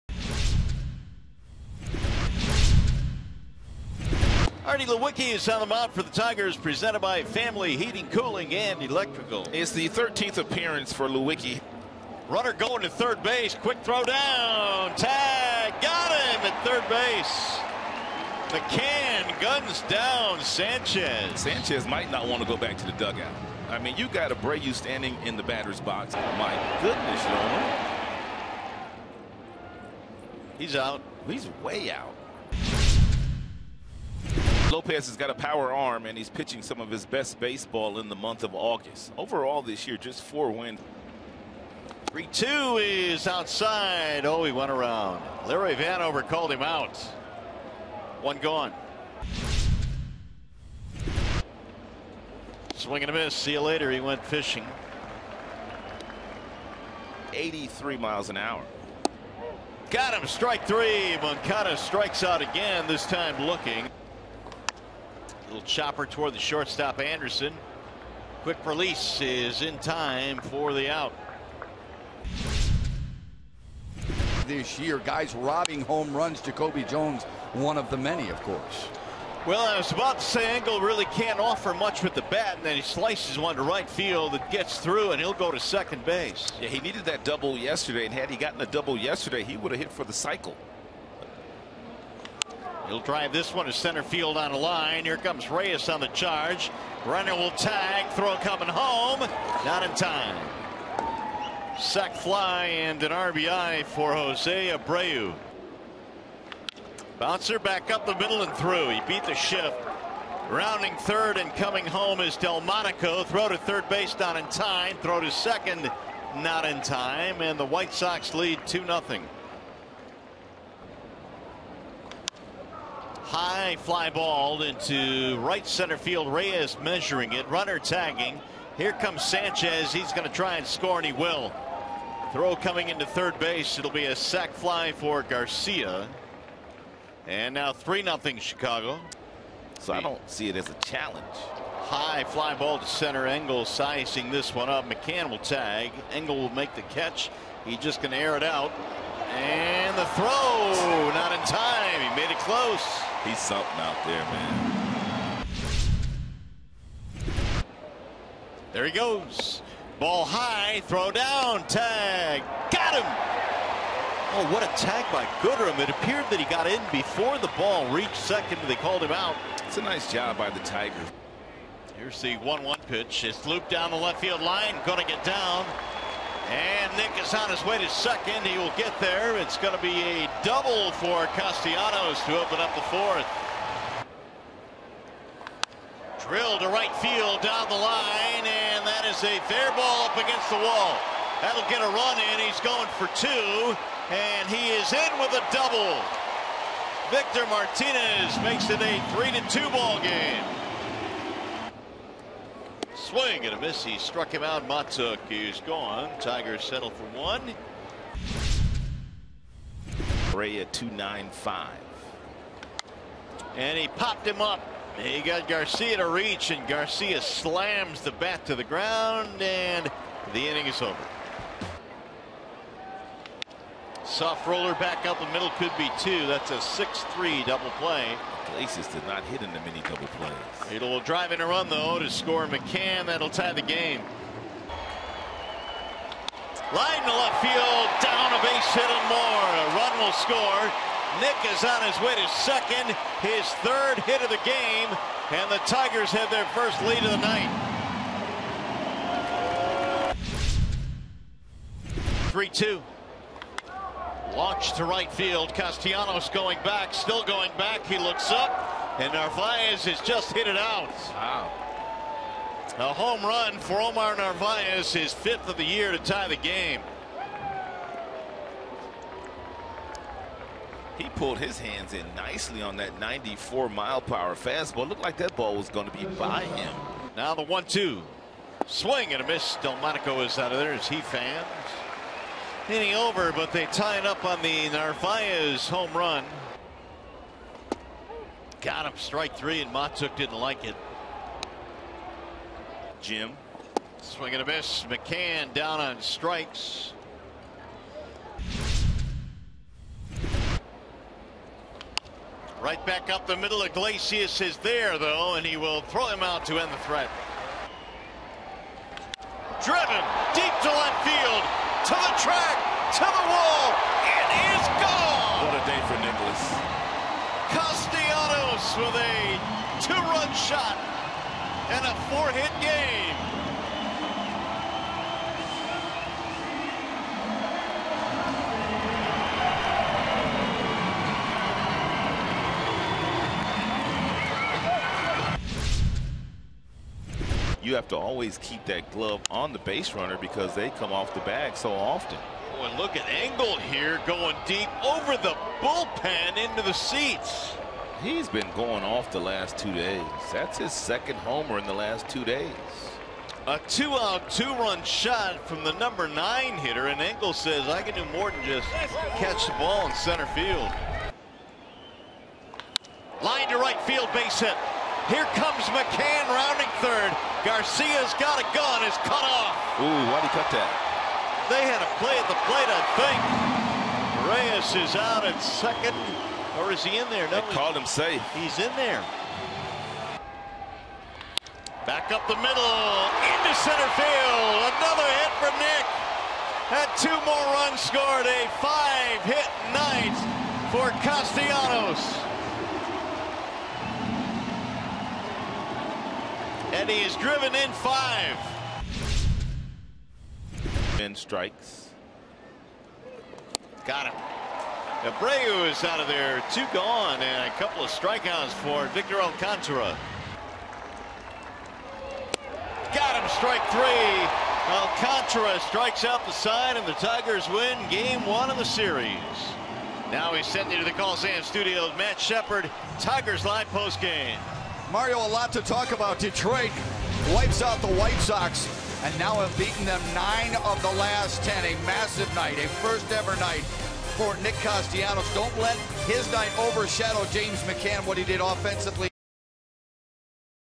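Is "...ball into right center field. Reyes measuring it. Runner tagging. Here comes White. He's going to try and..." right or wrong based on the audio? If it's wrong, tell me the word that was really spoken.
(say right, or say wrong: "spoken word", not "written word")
wrong: "Sanchez", not "White".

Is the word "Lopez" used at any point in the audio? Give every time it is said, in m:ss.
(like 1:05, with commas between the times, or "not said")
0:34.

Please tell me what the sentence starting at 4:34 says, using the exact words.
Looked like that ball was going to be by him.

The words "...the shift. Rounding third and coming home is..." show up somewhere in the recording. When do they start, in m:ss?
1:49.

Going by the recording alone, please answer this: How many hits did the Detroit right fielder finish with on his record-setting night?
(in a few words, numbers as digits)
5.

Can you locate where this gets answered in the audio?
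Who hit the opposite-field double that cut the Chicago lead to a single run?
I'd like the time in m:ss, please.
3:17.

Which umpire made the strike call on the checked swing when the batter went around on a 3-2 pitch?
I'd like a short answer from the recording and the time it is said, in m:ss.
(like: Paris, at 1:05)
Larry Vanover, at 0:45.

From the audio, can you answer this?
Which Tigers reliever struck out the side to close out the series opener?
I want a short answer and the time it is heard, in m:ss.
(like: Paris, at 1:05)
Victor Alcantara, at 6:48.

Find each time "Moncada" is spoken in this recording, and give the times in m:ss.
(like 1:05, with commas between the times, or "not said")
1:01.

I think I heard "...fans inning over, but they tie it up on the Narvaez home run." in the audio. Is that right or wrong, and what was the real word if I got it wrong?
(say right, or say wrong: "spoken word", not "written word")
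right.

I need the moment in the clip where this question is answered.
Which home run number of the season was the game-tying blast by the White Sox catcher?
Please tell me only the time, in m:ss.
4:25.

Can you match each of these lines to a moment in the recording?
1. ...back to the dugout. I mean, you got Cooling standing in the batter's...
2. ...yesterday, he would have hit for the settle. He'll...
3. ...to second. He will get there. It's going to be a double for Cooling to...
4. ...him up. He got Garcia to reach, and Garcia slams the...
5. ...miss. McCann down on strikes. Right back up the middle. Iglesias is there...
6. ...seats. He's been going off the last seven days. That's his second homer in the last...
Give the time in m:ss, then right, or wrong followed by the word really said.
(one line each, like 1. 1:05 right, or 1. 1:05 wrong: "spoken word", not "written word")
1. 0:22 wrong: "Abreu", not "Cooling"
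2. 1:28 wrong: "cycle", not "settle"
3. 2:57 wrong: "Castellanos", not "Cooling"
4. 3:34 right
5. 4:54 right
6. 5:46 wrong: "two", not "seven".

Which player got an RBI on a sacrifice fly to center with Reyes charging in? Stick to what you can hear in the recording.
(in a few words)
Jose Abreu.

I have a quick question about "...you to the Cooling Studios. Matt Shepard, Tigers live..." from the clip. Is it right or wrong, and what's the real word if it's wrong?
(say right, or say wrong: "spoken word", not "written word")
wrong: "Sam", not "Cooling".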